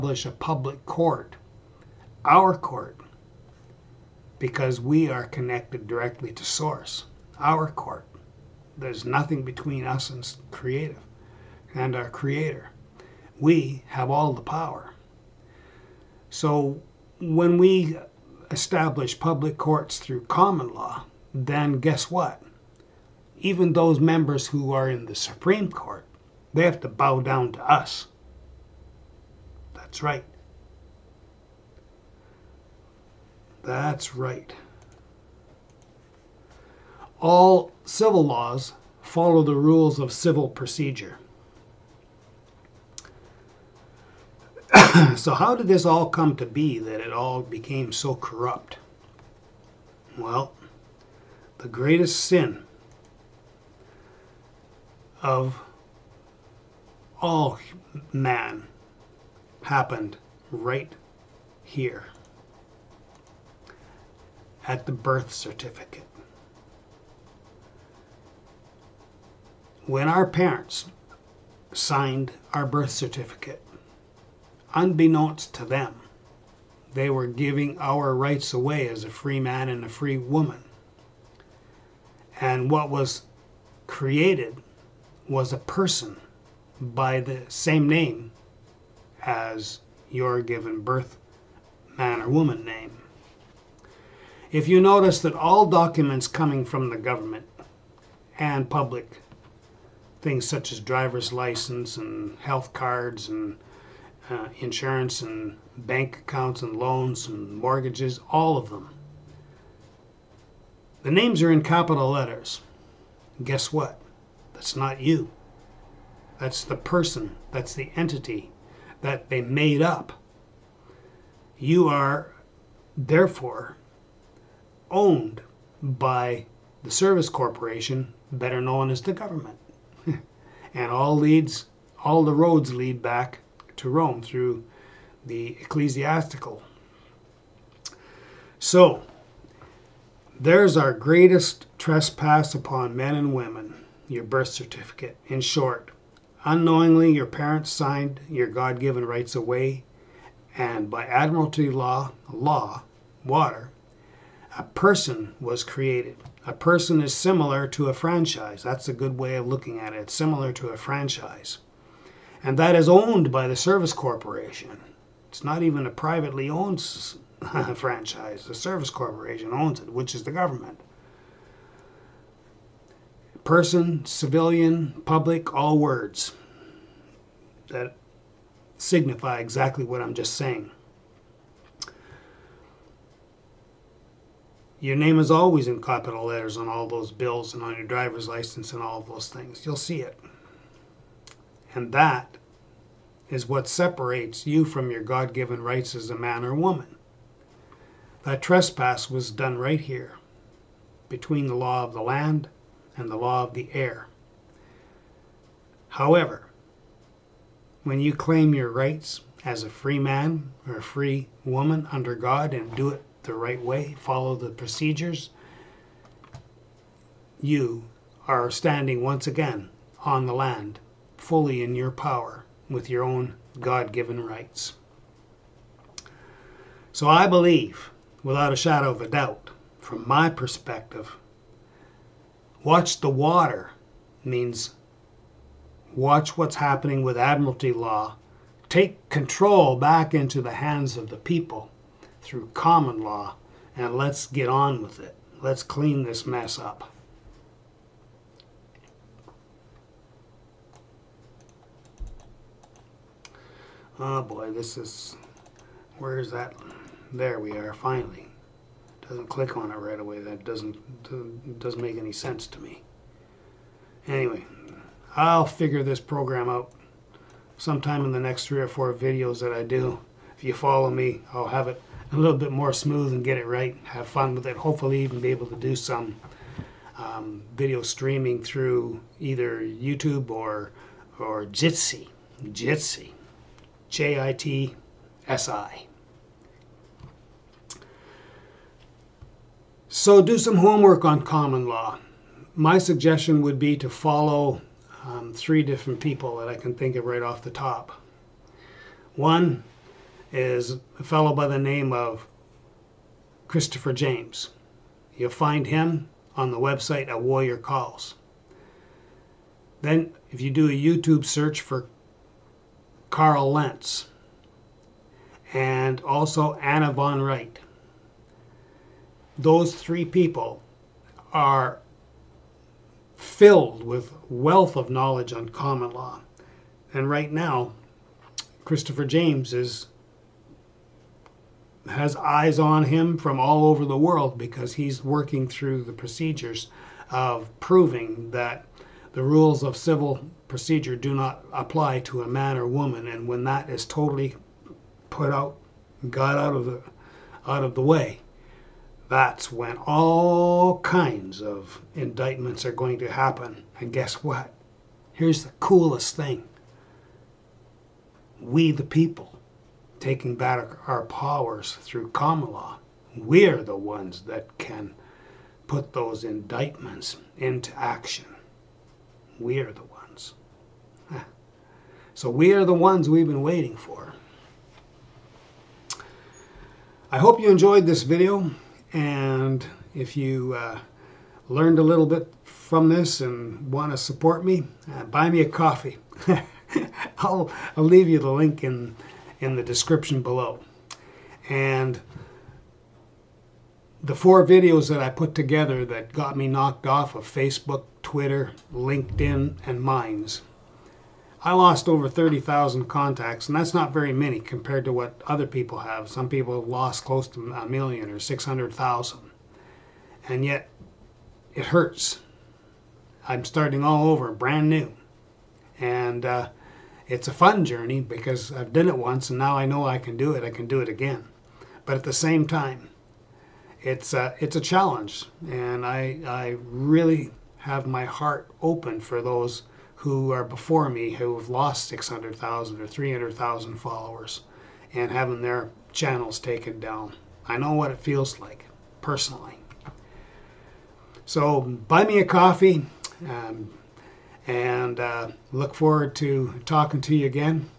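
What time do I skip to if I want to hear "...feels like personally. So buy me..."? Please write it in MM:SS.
07:17.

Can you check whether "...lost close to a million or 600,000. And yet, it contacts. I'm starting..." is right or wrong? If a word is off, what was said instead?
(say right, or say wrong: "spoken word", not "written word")
wrong: "hurts", not "contacts".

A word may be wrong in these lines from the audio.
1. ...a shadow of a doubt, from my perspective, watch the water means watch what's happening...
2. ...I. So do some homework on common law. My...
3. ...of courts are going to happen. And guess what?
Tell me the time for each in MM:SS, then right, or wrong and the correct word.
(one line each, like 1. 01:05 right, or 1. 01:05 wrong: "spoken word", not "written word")
1. 03:48 right
2. 04:45 right
3. 05:51 wrong: "indictments", not "courts".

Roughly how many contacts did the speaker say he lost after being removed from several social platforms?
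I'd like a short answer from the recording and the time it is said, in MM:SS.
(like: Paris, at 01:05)
30,000, at 06:42.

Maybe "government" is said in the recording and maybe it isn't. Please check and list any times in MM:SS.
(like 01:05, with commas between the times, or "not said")
01:36, 02:09, 02:50.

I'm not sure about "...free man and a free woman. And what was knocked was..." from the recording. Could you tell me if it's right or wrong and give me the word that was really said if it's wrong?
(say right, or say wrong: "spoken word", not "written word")
wrong: "created", not "knocked".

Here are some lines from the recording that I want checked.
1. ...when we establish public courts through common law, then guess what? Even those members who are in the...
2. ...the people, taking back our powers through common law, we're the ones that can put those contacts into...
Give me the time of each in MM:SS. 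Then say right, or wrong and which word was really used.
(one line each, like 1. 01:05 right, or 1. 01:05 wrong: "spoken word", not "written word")
1. 00:17 right
2. 05:58 wrong: "indictments", not "contacts".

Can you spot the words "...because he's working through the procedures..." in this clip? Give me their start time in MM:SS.
05:34.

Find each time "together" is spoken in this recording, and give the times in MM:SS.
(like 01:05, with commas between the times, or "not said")
06:35.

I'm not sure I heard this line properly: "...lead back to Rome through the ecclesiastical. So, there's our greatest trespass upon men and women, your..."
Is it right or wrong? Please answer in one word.
right.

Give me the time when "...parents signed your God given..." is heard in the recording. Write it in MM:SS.
02:27.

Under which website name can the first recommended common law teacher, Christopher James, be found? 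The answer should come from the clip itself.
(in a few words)
Warrior Calls.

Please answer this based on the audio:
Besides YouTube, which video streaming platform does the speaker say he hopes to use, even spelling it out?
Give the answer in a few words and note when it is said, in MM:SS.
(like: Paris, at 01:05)
Jitsi, at 04:42.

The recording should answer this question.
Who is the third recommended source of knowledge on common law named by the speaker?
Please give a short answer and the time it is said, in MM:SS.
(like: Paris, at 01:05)
Anna von Reitz, at 05:16.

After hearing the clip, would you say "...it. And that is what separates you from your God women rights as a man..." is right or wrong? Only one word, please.
wrong.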